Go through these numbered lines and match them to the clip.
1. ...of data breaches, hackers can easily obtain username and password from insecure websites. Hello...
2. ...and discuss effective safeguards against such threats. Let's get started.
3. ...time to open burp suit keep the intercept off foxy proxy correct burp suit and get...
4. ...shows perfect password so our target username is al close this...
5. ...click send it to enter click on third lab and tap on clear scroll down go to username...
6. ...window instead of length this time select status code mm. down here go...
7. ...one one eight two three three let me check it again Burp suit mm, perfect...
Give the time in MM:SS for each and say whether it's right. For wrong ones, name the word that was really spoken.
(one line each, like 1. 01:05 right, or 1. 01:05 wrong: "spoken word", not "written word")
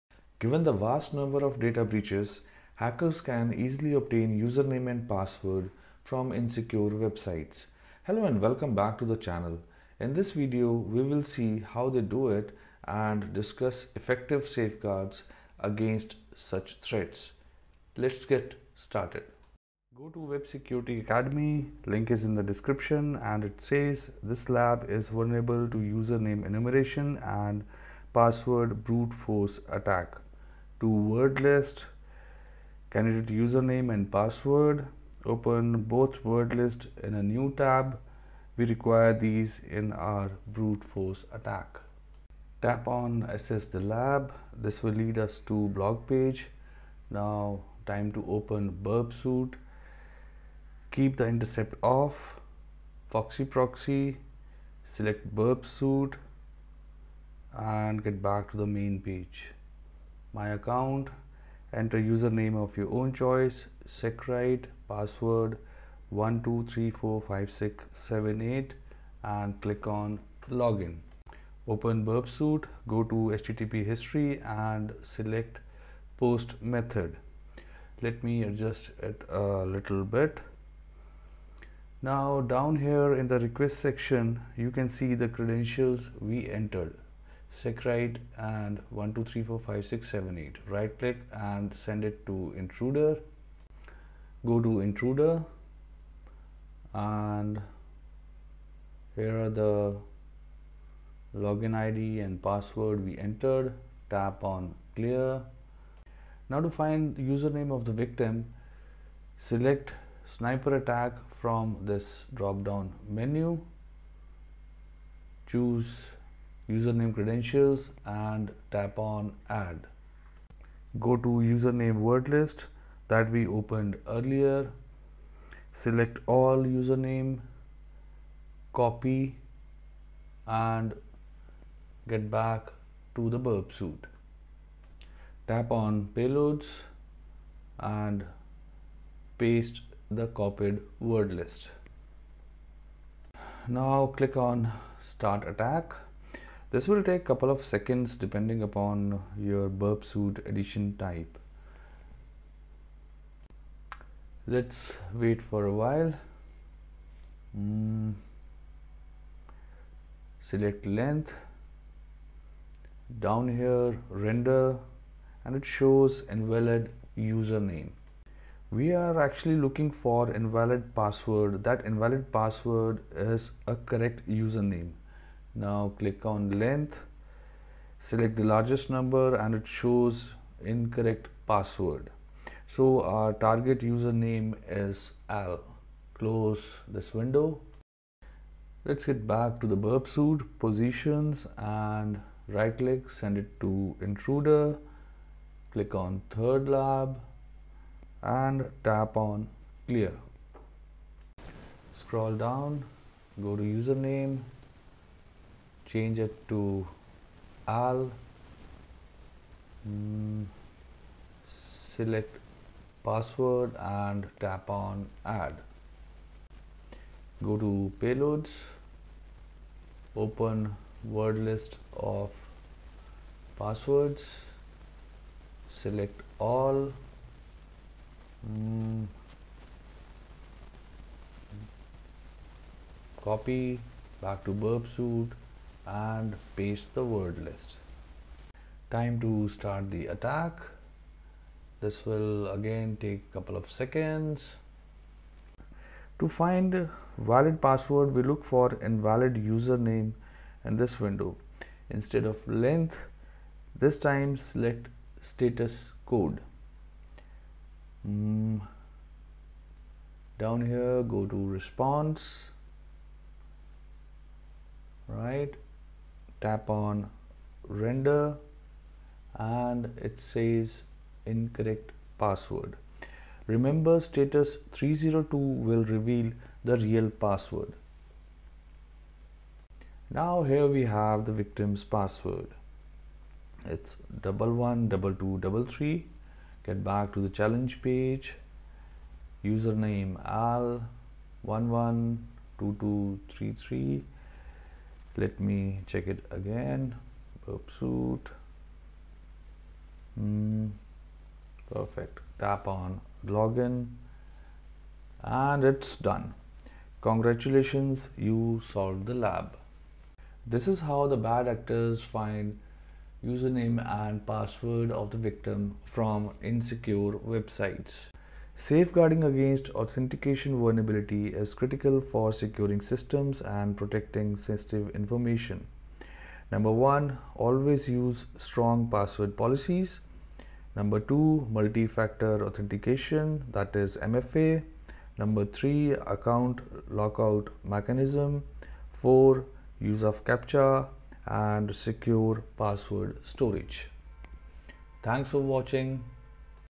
1. 00:01 right
2. 00:12 right
3. 00:47 wrong: "select", not "correct"
4. 02:59 wrong: "incorrect", not "perfect"
5. 03:12 wrong: "intruder", not "enter"
6. 04:10 right
7. 04:51 wrong: "two", not "eight".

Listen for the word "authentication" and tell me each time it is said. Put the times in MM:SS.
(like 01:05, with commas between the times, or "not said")
05:19, 05:32.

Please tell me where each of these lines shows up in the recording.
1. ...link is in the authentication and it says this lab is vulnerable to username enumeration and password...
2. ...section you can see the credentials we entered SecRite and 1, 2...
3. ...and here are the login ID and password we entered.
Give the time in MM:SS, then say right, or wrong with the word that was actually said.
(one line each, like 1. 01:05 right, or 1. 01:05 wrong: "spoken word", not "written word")
1. 00:21 wrong: "description", not "authentication"
2. 01:23 right
3. 01:36 right.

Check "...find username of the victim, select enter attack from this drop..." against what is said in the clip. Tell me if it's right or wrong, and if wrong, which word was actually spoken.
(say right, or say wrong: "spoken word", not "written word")
wrong: "sniper", not "enter".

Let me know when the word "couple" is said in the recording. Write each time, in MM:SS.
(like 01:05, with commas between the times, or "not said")
02:27, 04:03.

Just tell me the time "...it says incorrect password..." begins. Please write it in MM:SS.
04:30.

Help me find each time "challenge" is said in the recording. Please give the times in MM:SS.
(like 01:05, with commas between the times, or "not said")
04:47.